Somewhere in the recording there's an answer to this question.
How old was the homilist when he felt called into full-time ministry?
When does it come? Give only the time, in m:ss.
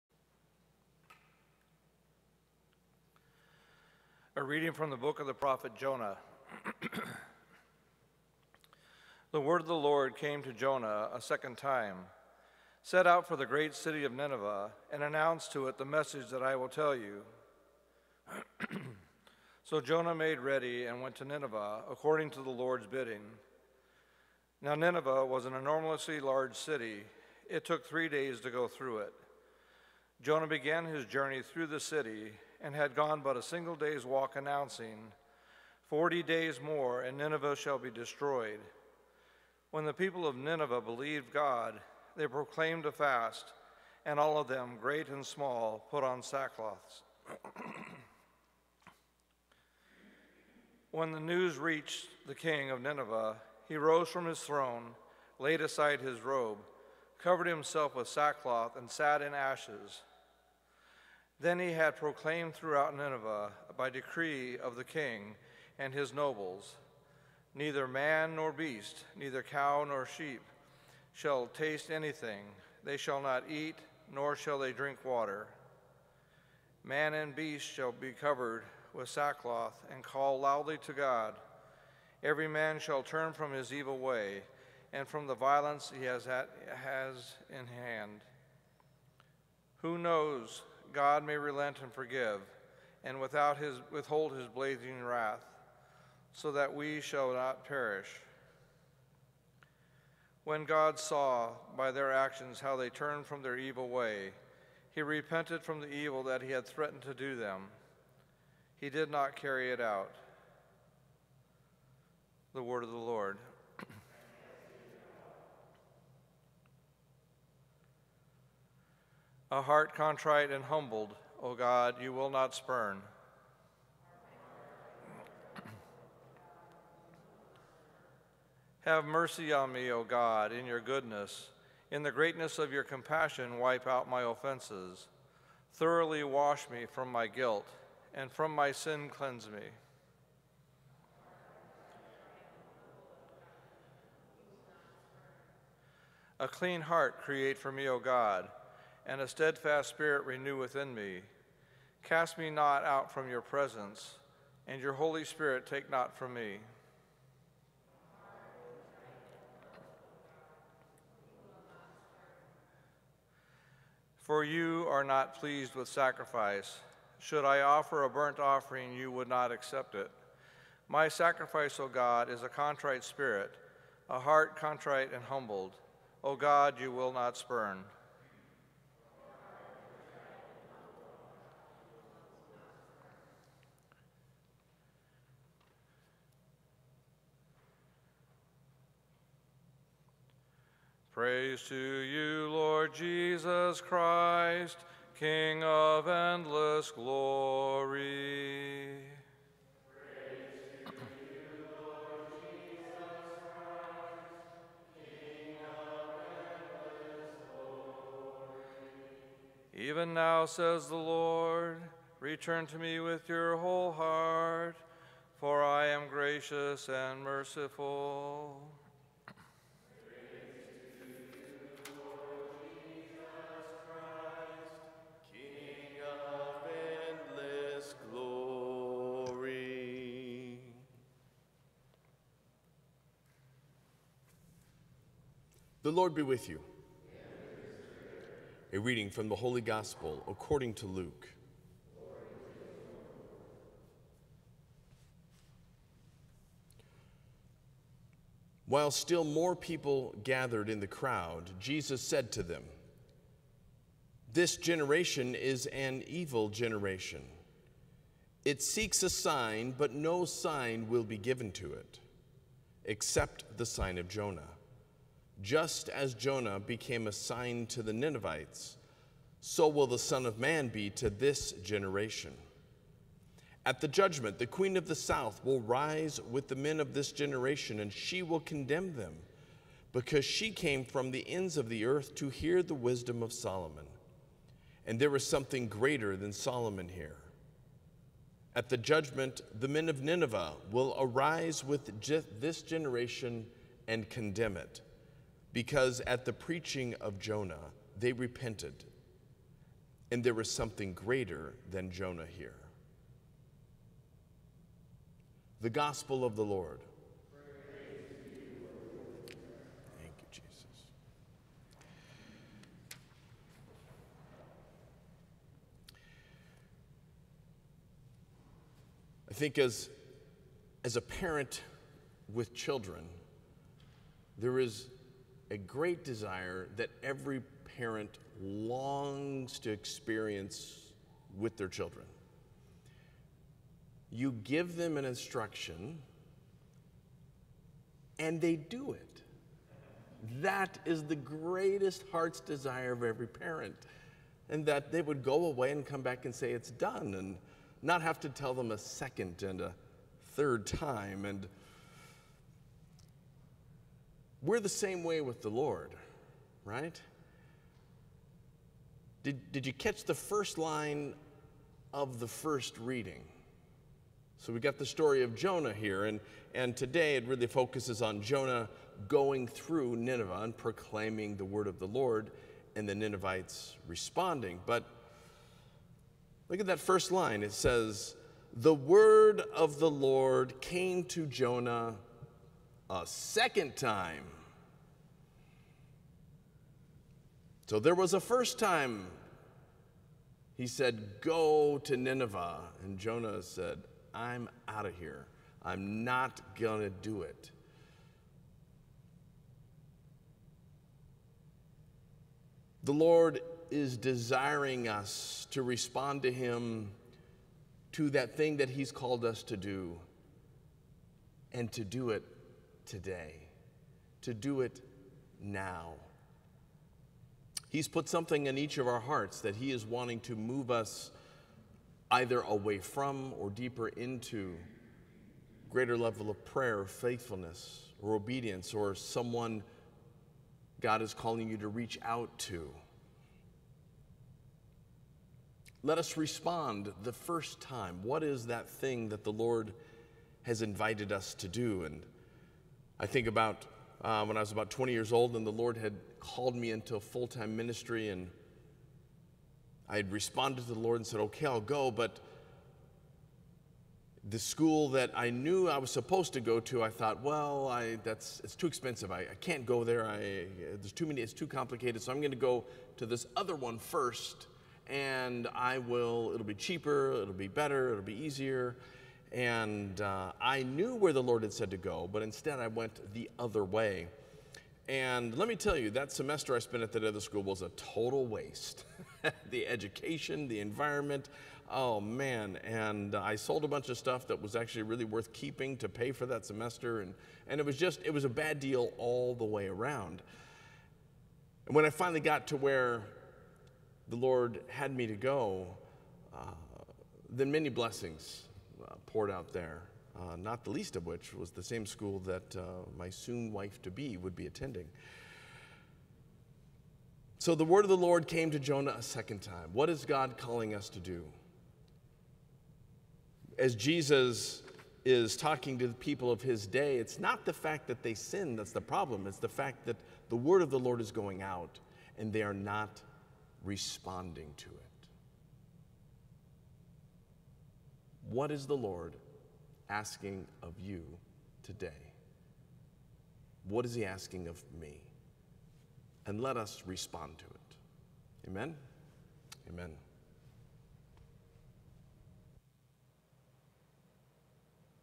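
7:24.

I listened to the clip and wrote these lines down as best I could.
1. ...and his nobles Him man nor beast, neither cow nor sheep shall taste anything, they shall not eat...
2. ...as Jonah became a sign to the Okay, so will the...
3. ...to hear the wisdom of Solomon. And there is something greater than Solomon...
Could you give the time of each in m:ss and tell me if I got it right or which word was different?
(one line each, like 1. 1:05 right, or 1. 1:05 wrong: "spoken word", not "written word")
1. 1:05 wrong: "Neither", not "Him"
2. 4:25 wrong: "Ninevites", not "Okay"
3. 4:42 right.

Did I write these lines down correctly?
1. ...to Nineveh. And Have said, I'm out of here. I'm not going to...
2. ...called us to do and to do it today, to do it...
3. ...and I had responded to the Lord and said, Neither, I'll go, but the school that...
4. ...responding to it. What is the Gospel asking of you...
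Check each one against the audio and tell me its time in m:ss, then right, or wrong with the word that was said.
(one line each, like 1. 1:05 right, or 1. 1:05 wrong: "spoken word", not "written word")
1. 6:31 wrong: "Jonah", not "Have"
2. 6:48 right
3. 7:28 wrong: "Okay", not "Neither"
4. 8:43 wrong: "Lord", not "Gospel".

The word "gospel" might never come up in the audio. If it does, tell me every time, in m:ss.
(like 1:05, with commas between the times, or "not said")
3:59, 5:05.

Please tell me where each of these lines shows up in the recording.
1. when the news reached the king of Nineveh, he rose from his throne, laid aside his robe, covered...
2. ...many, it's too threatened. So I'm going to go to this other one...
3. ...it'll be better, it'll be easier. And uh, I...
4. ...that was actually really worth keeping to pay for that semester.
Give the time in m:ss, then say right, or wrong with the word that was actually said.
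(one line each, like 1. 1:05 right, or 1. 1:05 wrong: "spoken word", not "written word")
1. 0:50 right
2. 7:41 wrong: "complicated", not "threatened"
3. 7:47 right
4. 8:04 right.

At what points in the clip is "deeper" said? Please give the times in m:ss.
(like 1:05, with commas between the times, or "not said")
7:03.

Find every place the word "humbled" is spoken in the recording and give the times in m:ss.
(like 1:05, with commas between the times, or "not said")
2:00, 2:55.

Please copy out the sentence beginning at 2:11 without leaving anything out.
In the greatness of your compassion, wipe out my offenses.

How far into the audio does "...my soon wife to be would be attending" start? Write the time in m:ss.
8:22.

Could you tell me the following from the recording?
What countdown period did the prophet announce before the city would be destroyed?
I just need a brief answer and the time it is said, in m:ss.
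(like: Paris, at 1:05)
40 days, at 0:35.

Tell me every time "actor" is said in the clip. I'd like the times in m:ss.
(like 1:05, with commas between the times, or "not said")
not said.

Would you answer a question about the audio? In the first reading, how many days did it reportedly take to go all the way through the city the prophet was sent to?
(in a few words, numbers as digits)
3.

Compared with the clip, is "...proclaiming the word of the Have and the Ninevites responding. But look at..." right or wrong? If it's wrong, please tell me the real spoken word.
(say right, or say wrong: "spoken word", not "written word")
wrong: "Lord", not "Have".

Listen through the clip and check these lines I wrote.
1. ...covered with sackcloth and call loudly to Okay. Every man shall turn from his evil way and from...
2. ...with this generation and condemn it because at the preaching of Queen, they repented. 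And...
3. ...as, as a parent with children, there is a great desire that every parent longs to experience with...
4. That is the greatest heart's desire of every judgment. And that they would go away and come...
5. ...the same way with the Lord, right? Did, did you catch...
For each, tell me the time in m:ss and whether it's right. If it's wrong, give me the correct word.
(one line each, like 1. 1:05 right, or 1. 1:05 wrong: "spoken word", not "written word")
1. 1:18 wrong: "God", not "Okay"
2. 4:51 wrong: "Jonah", not "Queen"
3. 5:19 right
4. 5:40 wrong: "parent", not "judgment"
5. 5:54 right.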